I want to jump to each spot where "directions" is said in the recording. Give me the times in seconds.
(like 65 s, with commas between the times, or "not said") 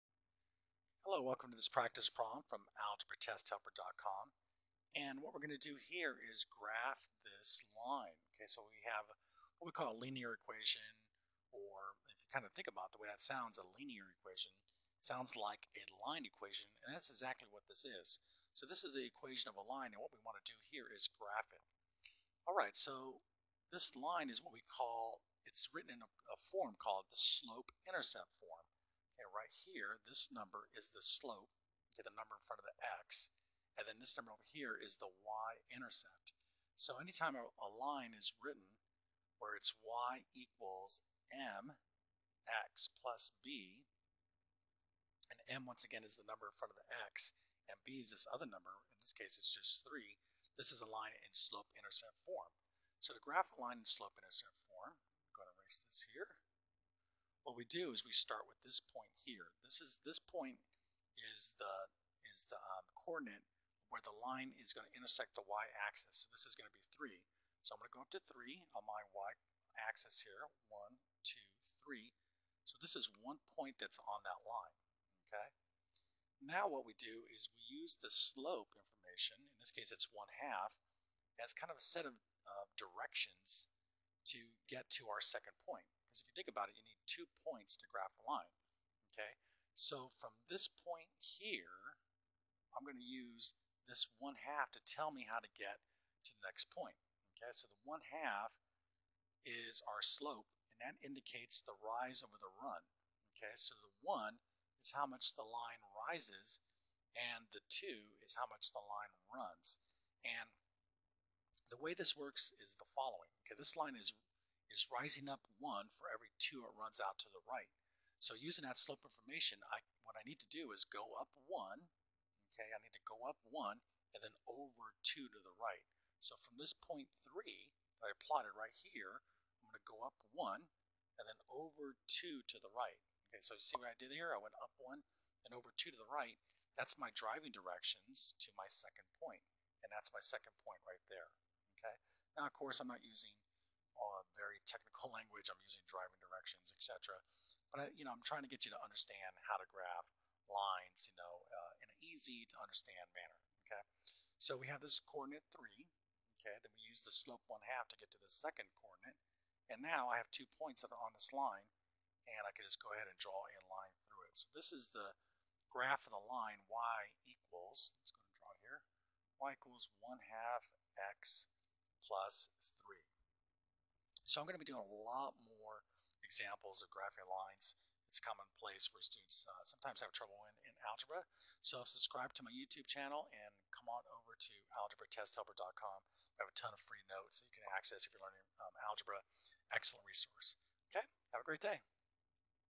82 s, 137 s, 146 s.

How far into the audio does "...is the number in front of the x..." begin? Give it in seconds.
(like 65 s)
46 s.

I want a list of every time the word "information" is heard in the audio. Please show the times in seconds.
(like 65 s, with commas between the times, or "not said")
78 s, 119 s.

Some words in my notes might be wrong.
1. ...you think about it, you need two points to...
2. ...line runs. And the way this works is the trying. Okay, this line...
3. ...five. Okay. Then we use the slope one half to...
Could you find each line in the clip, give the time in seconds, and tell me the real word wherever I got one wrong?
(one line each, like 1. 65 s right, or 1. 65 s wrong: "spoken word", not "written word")
1. 86 s right
2. 108 s wrong: "following", not "trying"
3. 155 s wrong: "three", not "five".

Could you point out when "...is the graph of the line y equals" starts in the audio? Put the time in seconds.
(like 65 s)
164 s.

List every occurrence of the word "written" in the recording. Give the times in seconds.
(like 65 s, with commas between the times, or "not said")
25 s, 38 s.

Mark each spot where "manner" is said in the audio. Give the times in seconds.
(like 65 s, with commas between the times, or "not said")
153 s.